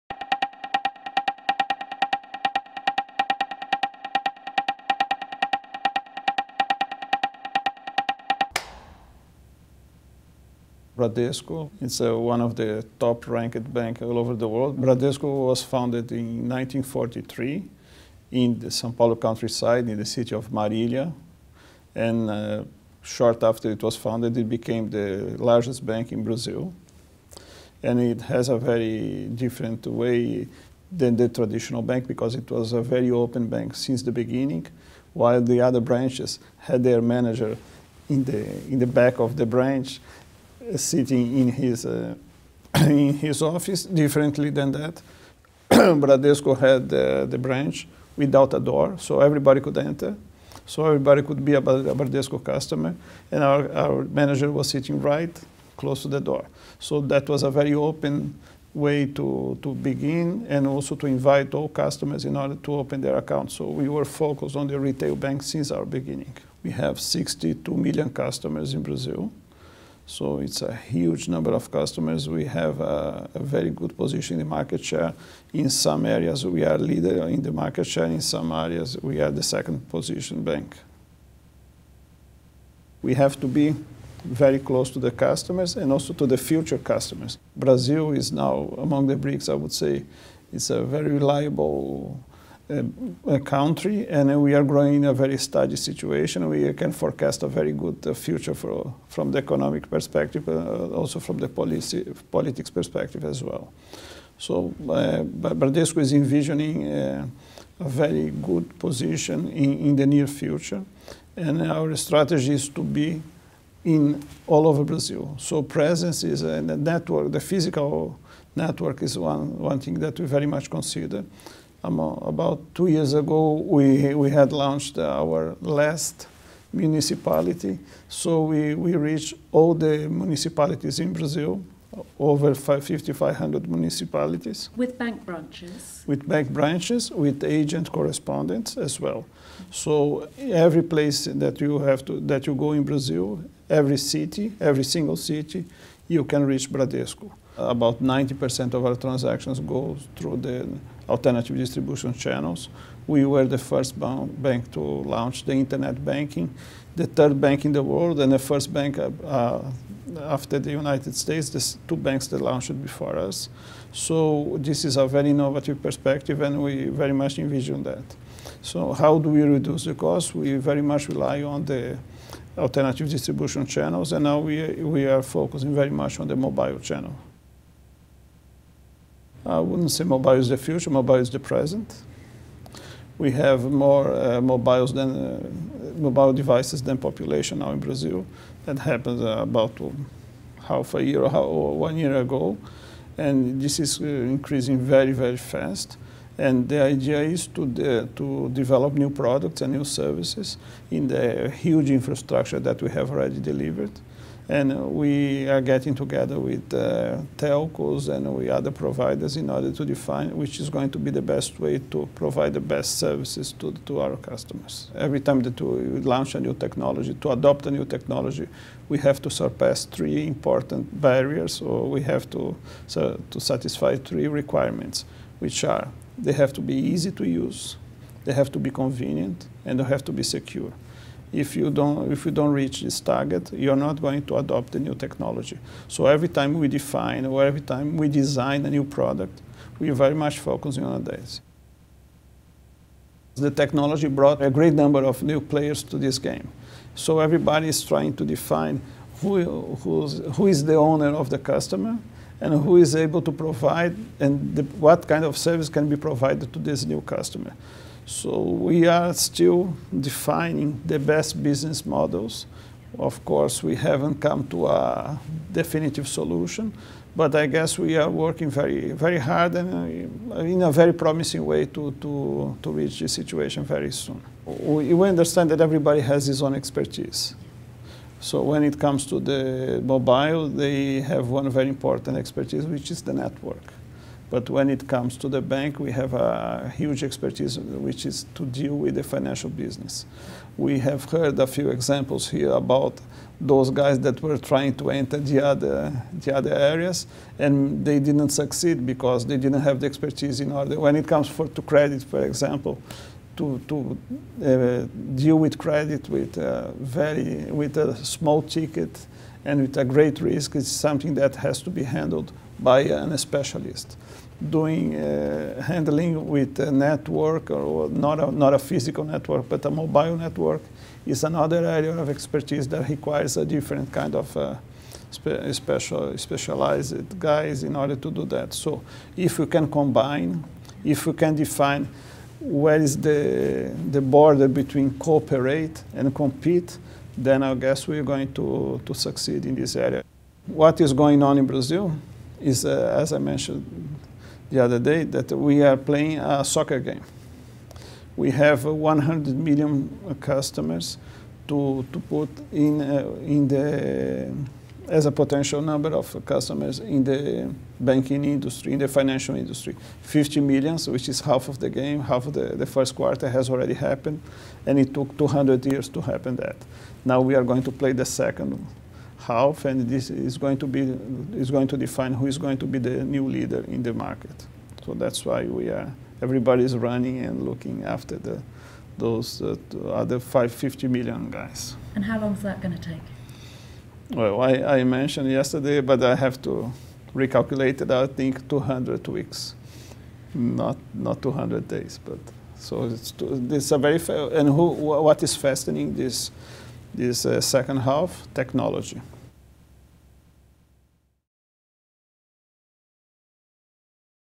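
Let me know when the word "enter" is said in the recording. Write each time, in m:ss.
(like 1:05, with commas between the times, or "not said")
0:49, 4:54.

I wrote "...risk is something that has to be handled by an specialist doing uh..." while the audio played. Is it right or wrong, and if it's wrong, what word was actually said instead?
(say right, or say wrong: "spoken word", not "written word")
right.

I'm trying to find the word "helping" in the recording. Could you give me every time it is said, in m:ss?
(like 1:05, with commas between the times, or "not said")
not said.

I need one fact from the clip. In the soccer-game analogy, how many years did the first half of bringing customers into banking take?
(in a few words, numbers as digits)
200 years.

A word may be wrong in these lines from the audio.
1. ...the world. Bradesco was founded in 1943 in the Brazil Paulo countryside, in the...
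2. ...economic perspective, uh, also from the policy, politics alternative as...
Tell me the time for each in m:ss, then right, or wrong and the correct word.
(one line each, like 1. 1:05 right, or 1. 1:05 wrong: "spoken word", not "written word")
1. 0:14 wrong: "São", not "Brazil"
2. 1:39 wrong: "perspective", not "alternative".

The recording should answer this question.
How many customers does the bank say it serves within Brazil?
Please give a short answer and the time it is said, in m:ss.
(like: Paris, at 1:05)
62 million, at 1:07.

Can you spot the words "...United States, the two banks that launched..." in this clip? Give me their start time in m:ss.
2:40.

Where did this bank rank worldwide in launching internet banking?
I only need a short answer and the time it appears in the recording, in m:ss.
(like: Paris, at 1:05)
third, at 2:36.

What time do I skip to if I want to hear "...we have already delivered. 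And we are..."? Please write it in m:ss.
3:22.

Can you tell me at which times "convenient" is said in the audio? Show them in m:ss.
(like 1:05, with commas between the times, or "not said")
3:48.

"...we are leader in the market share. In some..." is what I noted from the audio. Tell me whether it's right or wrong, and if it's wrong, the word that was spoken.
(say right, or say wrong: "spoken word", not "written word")
right.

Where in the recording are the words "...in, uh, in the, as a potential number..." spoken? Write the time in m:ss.
5:52.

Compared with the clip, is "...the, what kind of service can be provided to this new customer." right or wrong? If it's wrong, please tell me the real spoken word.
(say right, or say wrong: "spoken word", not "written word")
right.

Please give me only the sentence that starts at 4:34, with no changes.
We, we understand that everybody has his own expertise.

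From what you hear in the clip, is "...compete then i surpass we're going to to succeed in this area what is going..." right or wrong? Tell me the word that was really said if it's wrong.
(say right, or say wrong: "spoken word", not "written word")
wrong: "guess", not "surpass".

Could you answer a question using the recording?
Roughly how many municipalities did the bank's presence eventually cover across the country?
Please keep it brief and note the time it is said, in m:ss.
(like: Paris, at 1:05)
5,500, at 2:12.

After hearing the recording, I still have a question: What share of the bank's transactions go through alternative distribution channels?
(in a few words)
90%.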